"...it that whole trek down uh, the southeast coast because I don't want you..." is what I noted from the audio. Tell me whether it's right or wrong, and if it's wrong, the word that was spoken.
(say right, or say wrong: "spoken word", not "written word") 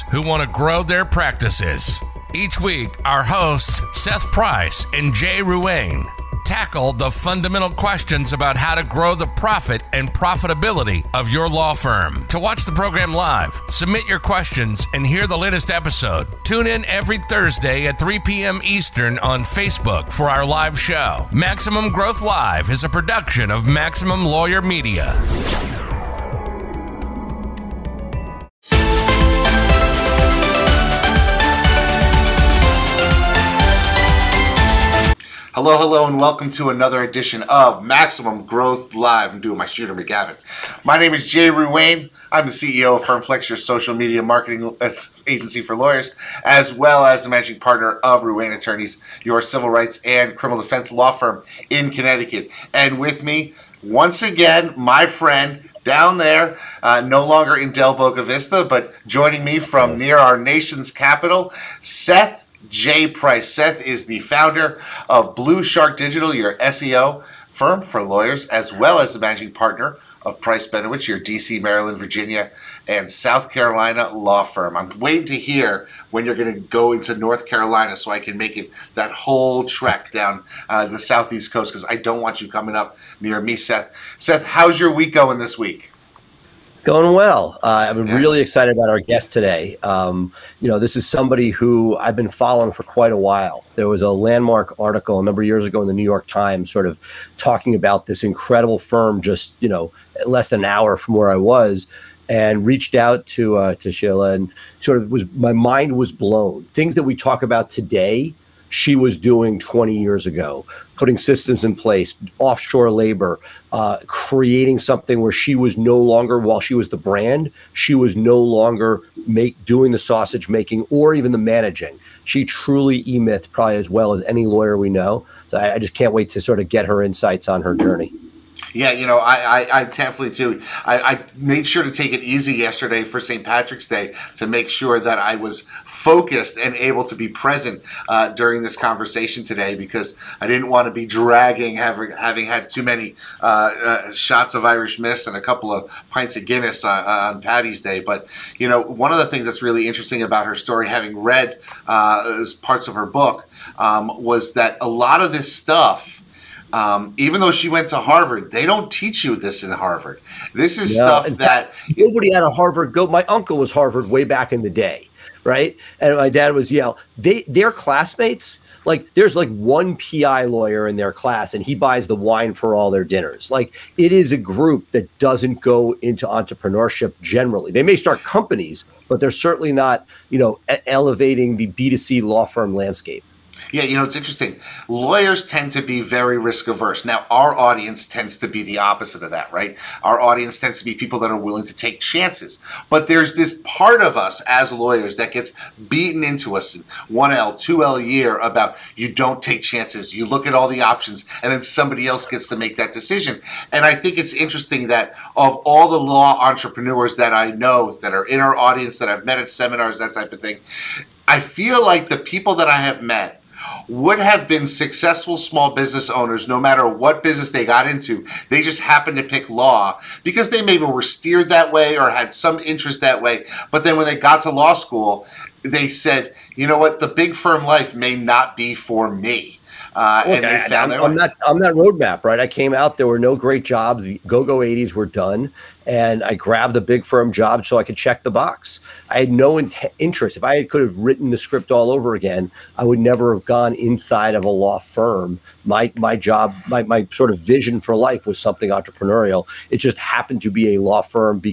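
right.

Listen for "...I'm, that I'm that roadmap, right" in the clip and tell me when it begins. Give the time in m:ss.
3:51.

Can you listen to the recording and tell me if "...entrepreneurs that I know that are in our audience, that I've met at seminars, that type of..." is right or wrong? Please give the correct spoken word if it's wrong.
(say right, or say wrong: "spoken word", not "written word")
right.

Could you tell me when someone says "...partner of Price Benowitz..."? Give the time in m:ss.
1:09.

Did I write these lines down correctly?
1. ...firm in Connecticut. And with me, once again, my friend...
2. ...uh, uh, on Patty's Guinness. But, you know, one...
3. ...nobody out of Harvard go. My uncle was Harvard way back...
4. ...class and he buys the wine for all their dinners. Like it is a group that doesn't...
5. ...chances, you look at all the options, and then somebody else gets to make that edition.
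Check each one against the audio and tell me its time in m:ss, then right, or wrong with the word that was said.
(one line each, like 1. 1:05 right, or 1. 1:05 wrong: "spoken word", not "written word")
1. 0:51 right
2. 2:26 wrong: "Day", not "Guinness"
3. 2:41 right
4. 2:51 right
5. 3:19 wrong: "decision", not "edition".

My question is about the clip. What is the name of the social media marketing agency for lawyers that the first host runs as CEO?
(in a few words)
FirmFlex.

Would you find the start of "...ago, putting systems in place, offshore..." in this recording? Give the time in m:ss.
1:50.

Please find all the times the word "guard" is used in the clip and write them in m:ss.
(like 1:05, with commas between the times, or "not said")
not said.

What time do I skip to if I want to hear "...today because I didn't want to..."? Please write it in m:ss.
2:19.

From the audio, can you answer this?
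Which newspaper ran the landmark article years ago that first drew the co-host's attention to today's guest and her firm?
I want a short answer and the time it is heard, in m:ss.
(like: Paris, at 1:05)
New York Times, at 1:35.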